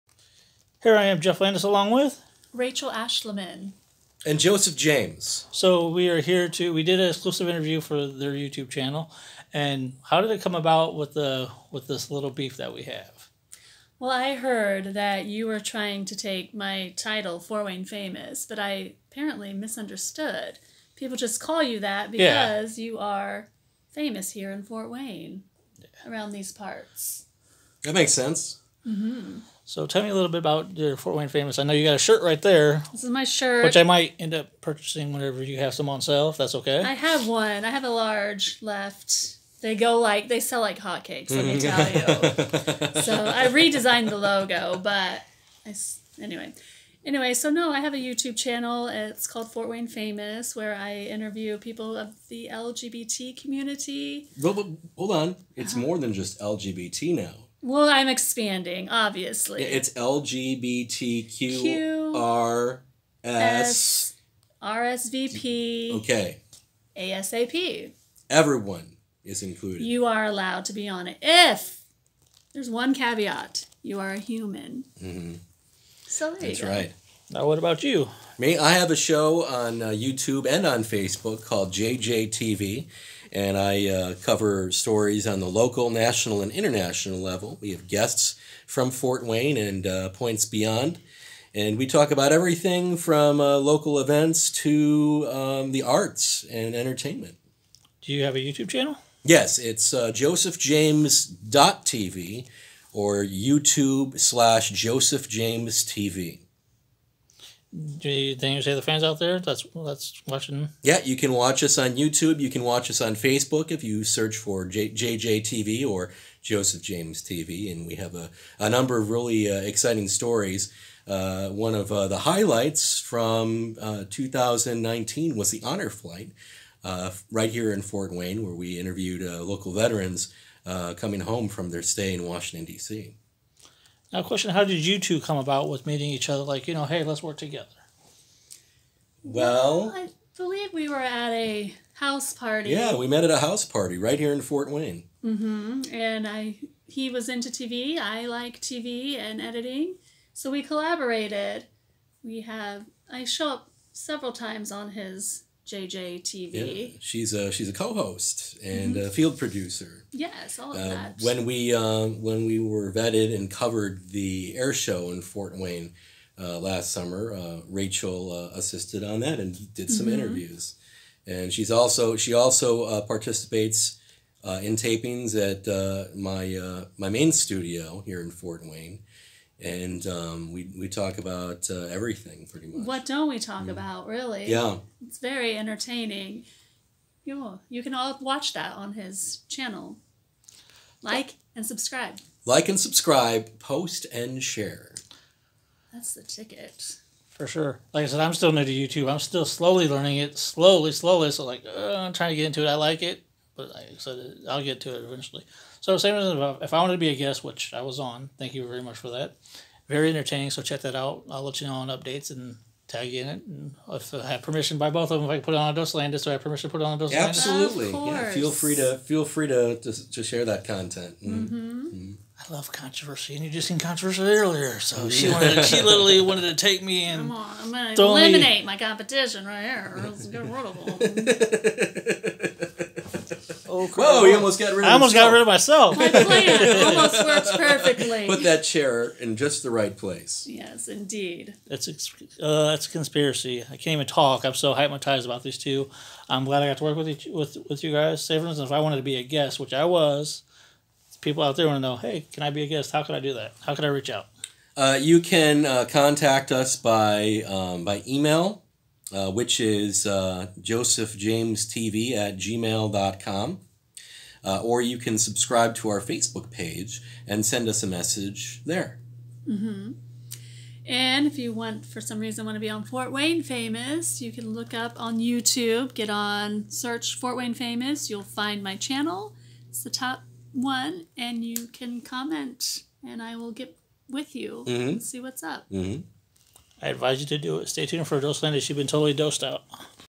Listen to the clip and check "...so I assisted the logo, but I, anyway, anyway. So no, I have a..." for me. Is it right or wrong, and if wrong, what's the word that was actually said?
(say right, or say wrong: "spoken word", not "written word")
wrong: "redesigned", not "assisted".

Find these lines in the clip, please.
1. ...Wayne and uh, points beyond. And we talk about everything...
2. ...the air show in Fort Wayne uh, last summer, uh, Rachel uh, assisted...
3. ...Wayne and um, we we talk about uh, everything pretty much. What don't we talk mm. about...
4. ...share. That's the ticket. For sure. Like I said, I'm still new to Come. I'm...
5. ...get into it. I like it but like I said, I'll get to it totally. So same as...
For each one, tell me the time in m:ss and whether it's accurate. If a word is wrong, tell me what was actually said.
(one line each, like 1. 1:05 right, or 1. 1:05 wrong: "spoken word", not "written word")
1. 1:29 right
2. 2:44 right
3. 2:58 right
4. 3:14 wrong: "YouTube", not "Come"
5. 3:22 wrong: "eventually", not "totally".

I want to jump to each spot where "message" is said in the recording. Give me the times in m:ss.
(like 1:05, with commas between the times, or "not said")
4:27.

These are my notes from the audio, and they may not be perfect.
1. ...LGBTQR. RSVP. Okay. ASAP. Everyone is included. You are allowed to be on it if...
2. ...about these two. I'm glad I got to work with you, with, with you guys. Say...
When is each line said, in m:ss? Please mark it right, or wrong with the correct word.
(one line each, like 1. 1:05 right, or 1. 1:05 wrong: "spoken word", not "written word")
1. 0:59 right
2. 4:05 right.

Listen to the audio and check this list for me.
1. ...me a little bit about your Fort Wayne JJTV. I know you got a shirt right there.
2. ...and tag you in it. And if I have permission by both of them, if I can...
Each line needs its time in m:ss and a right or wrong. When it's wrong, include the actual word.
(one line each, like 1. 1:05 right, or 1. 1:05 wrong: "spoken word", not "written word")
1. 0:30 wrong: "Famous", not "JJTV"
2. 3:32 right.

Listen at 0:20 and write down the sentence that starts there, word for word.
People just call you that because yeah.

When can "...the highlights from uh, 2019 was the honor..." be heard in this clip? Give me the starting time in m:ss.
2:02.